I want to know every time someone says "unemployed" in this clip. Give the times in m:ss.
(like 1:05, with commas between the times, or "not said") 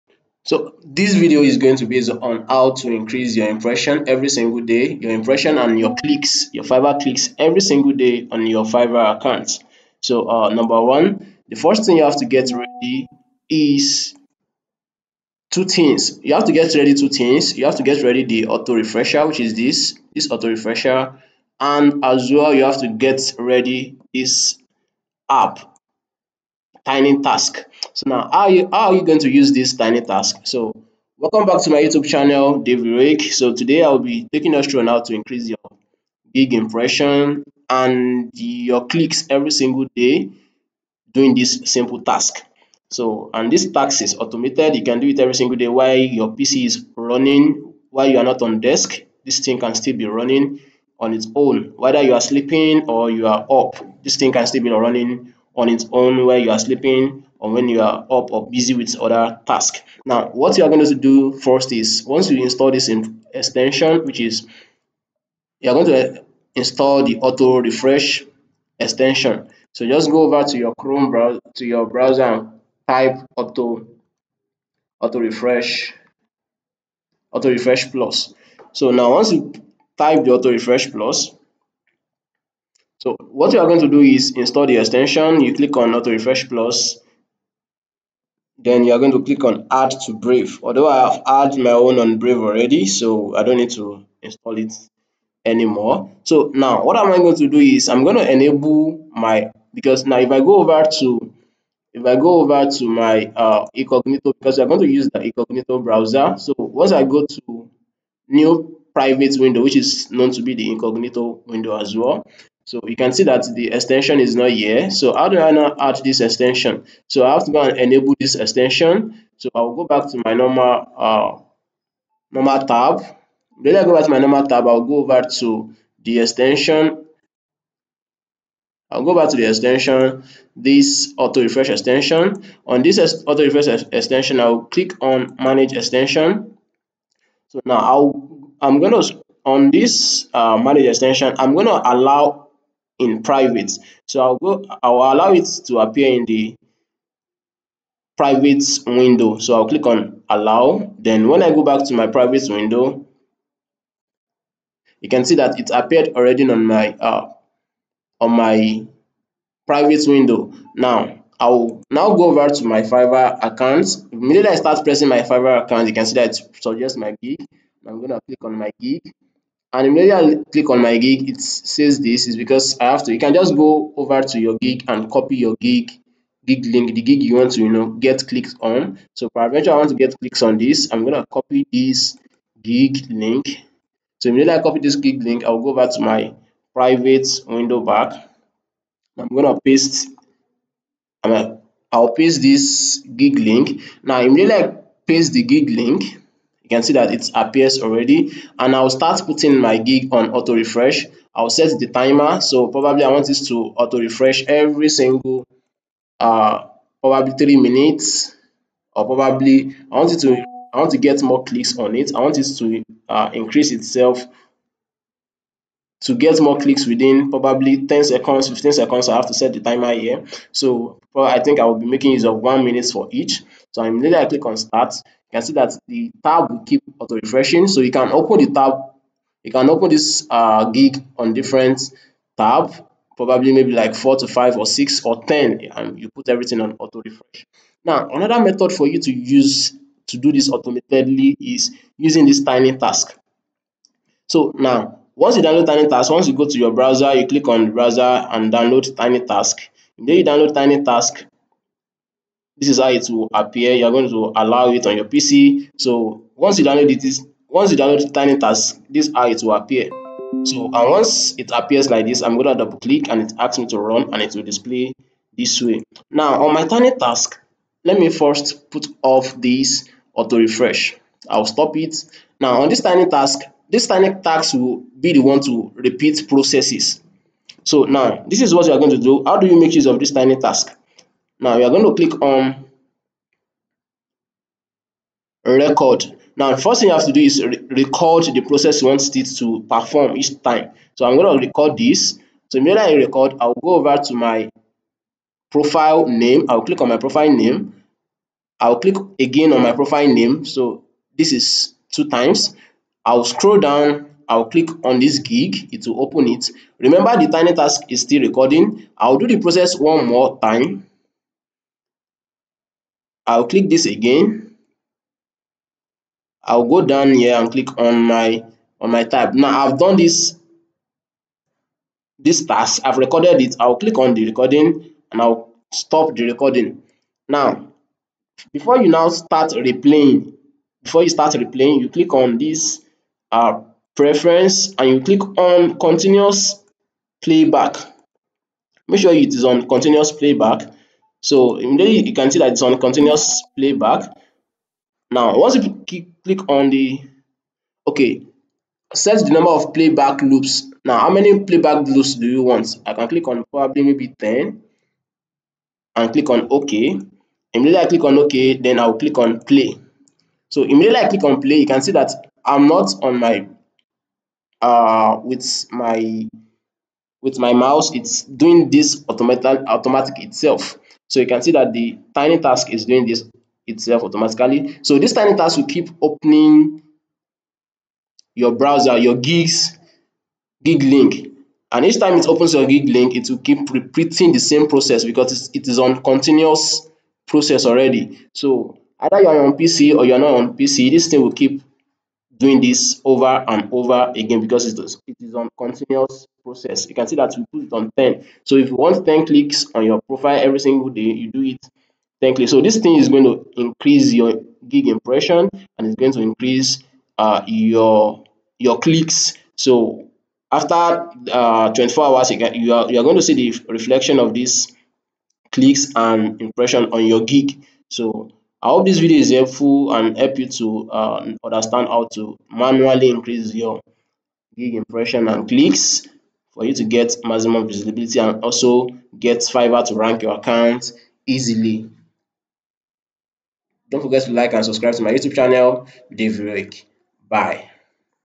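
not said.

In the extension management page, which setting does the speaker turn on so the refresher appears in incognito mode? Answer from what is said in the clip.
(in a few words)
Allow in private.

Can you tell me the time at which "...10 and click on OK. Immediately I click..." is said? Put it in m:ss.
5:54.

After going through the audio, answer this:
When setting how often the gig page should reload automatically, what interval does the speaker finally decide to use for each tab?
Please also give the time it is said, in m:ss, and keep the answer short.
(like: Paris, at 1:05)
1 minute, at 3:42.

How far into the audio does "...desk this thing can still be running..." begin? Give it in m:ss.
0:48.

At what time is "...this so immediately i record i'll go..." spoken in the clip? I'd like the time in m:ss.
4:51.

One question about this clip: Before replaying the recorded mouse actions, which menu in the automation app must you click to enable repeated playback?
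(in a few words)
Preference.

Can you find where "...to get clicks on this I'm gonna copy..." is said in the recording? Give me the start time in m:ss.
2:59.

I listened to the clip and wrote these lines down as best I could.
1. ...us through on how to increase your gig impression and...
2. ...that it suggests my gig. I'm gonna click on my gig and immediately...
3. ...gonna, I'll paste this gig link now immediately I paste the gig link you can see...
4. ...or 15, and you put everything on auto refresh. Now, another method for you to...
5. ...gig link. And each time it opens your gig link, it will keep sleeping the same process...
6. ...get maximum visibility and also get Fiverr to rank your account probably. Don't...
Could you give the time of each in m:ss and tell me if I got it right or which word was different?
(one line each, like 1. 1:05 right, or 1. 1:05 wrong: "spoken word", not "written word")
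1. 0:34 right
2. 2:46 right
3. 3:11 right
4. 3:55 wrong: "10", not "15"
5. 6:20 wrong: "repeating", not "sleeping"
6. 7:06 wrong: "easily", not "probably".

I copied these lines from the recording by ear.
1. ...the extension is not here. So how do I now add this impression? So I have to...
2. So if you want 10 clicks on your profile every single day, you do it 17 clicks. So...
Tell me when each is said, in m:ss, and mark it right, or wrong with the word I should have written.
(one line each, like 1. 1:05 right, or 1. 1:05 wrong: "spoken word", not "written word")
1. 1:53 wrong: "extension", not "impression"
2. 6:38 wrong: "10", not "17".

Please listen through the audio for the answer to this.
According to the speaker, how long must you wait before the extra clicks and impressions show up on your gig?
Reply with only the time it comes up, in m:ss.
6:51.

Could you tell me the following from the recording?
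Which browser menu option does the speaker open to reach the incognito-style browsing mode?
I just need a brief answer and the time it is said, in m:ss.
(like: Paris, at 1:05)
New private window, at 1:48.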